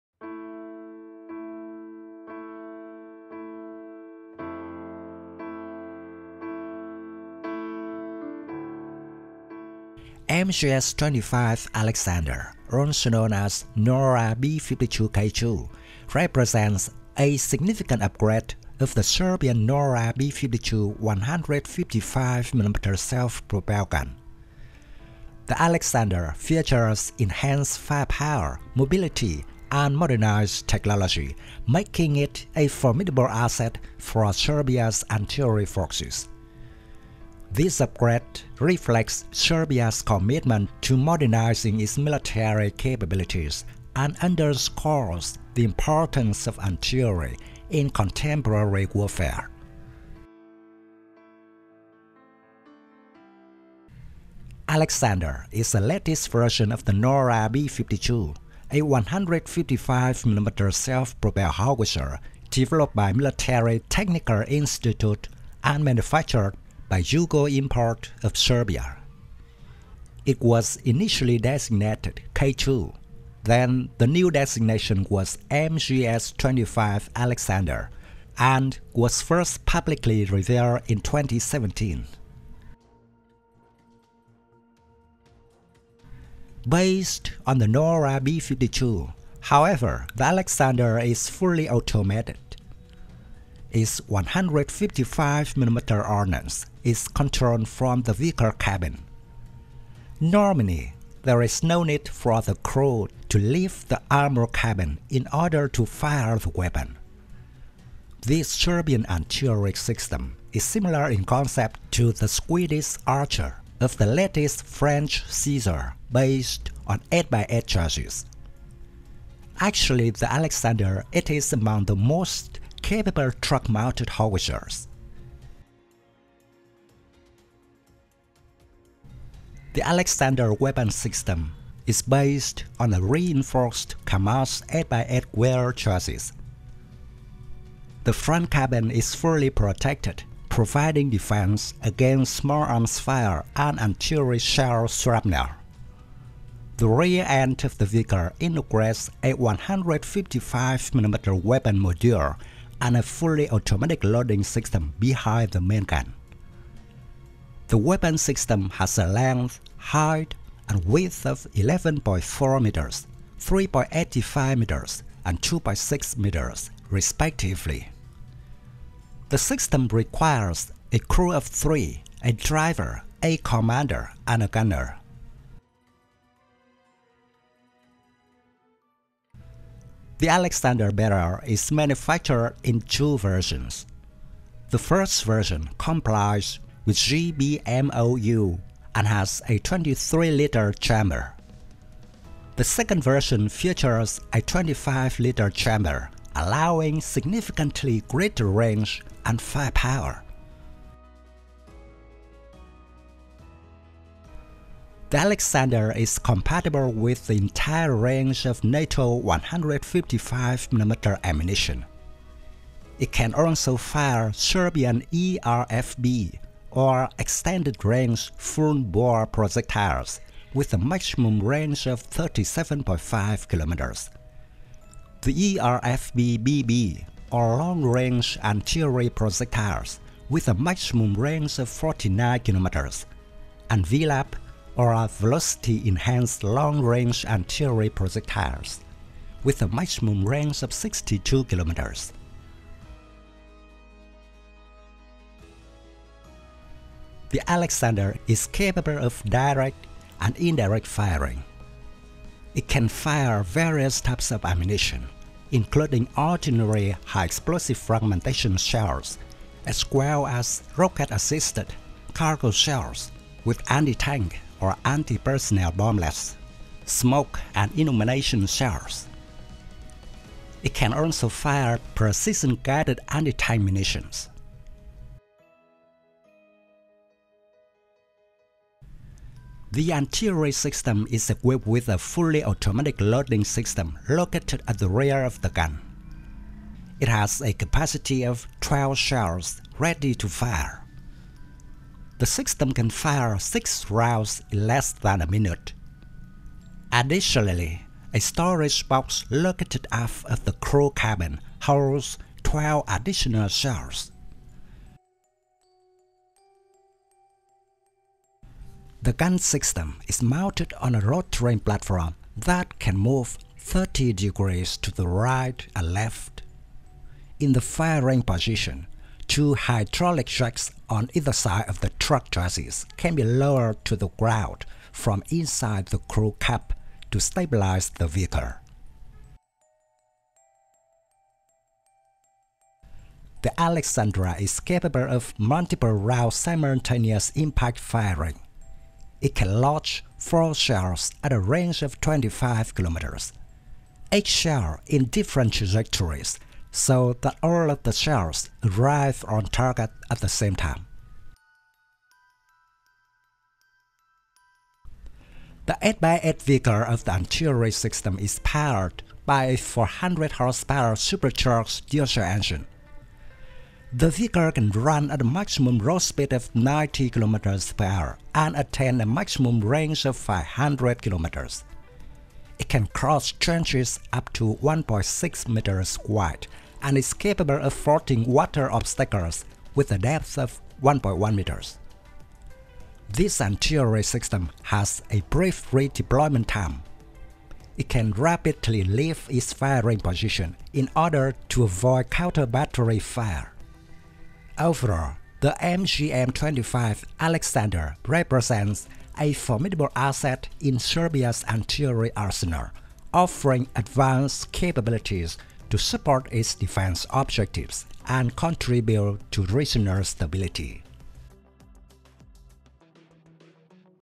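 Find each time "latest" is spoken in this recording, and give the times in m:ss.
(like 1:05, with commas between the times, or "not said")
0:55, 1:54.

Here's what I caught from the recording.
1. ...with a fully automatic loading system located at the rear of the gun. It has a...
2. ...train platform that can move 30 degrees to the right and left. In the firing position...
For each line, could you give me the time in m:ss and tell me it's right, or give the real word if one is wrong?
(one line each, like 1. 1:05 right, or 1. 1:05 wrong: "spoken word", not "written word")
1. 4:41 right
2. 5:11 right.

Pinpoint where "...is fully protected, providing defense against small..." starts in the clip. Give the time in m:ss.
2:18.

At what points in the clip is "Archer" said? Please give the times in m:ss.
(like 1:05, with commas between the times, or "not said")
1:53.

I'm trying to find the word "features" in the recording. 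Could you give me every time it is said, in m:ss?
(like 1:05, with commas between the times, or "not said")
0:26, 3:13.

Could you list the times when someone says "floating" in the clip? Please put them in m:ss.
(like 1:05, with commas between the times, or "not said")
6:17.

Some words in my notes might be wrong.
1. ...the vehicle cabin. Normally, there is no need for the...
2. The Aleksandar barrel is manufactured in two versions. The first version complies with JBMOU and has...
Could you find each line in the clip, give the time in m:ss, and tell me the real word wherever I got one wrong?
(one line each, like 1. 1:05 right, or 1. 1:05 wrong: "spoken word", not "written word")
1. 1:38 right
2. 3:00 right.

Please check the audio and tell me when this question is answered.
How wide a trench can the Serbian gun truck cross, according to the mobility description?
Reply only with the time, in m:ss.
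6:14.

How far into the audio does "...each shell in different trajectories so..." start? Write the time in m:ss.
5:44.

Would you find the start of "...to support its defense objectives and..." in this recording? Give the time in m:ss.
6:45.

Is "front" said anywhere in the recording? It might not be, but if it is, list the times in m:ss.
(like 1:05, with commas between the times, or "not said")
2:18.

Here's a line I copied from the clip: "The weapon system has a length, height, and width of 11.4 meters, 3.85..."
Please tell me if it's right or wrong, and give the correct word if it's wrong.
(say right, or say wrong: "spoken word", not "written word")
right.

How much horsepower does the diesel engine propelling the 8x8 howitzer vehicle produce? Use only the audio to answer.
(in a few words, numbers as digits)
400.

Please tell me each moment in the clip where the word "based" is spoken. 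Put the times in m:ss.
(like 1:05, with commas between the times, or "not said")
1:26, 1:56, 2:12.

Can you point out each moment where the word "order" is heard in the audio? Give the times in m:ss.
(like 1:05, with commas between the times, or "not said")
1:45, 6:30.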